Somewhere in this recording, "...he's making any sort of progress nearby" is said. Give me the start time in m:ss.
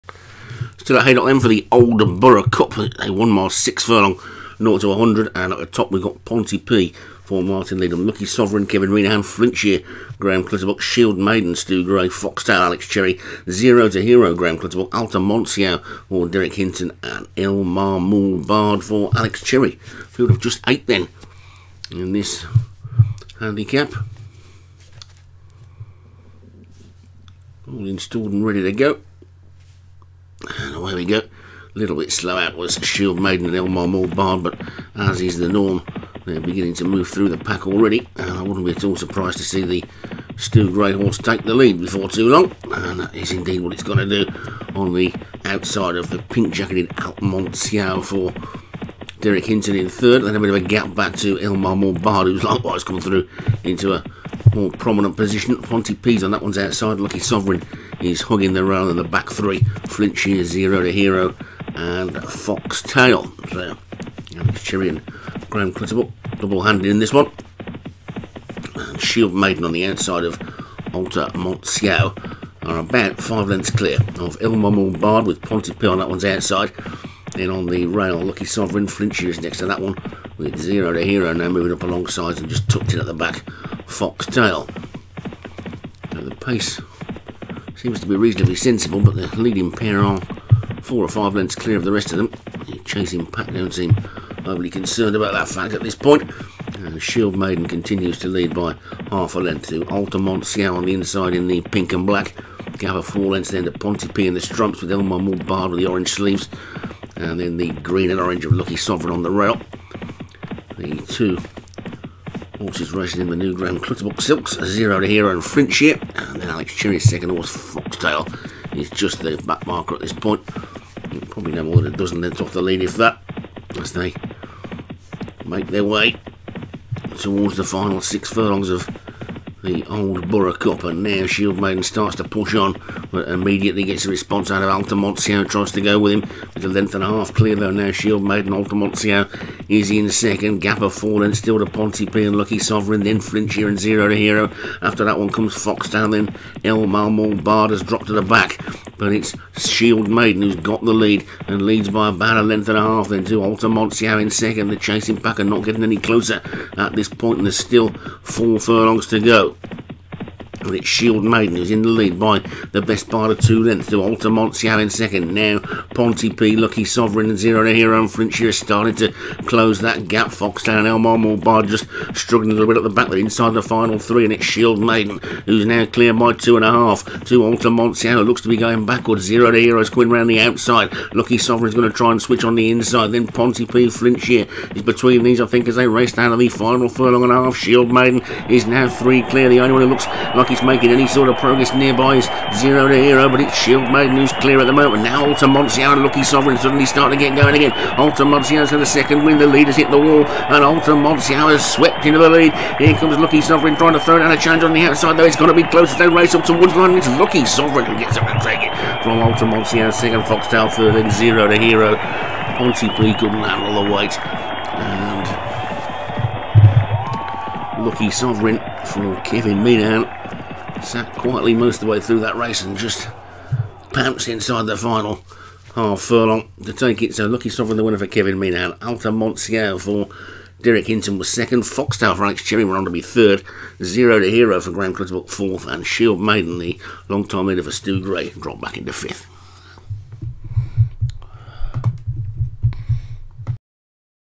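3:10.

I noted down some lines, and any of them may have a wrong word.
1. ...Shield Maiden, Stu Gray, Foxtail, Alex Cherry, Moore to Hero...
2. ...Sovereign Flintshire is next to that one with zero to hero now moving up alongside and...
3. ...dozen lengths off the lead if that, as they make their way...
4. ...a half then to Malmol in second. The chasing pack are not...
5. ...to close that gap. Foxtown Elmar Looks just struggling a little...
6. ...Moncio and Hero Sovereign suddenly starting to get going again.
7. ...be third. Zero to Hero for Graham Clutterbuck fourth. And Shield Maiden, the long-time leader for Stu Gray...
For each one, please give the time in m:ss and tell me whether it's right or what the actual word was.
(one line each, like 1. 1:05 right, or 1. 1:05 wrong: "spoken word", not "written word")
1. 0:10 wrong: "Zero", not "Moore"
2. 1:18 right
3. 2:01 right
4. 2:32 wrong: "Altamoncio", not "Malmol"
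5. 2:48 wrong: "Moore", not "Looks"
6. 3:15 wrong: "Lucky", not "Hero"
7. 3:52 right.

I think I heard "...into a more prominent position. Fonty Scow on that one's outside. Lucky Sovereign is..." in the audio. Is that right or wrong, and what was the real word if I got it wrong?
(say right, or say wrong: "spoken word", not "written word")
wrong: "Pease", not "Scow".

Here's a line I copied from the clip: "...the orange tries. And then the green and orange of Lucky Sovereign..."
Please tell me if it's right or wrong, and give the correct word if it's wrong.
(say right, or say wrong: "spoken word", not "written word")
wrong: "sleeves", not "tries".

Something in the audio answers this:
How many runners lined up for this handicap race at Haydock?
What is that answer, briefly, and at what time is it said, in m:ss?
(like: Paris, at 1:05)
8, at 0:20.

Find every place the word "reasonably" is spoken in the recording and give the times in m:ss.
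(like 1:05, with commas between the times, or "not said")
1:28.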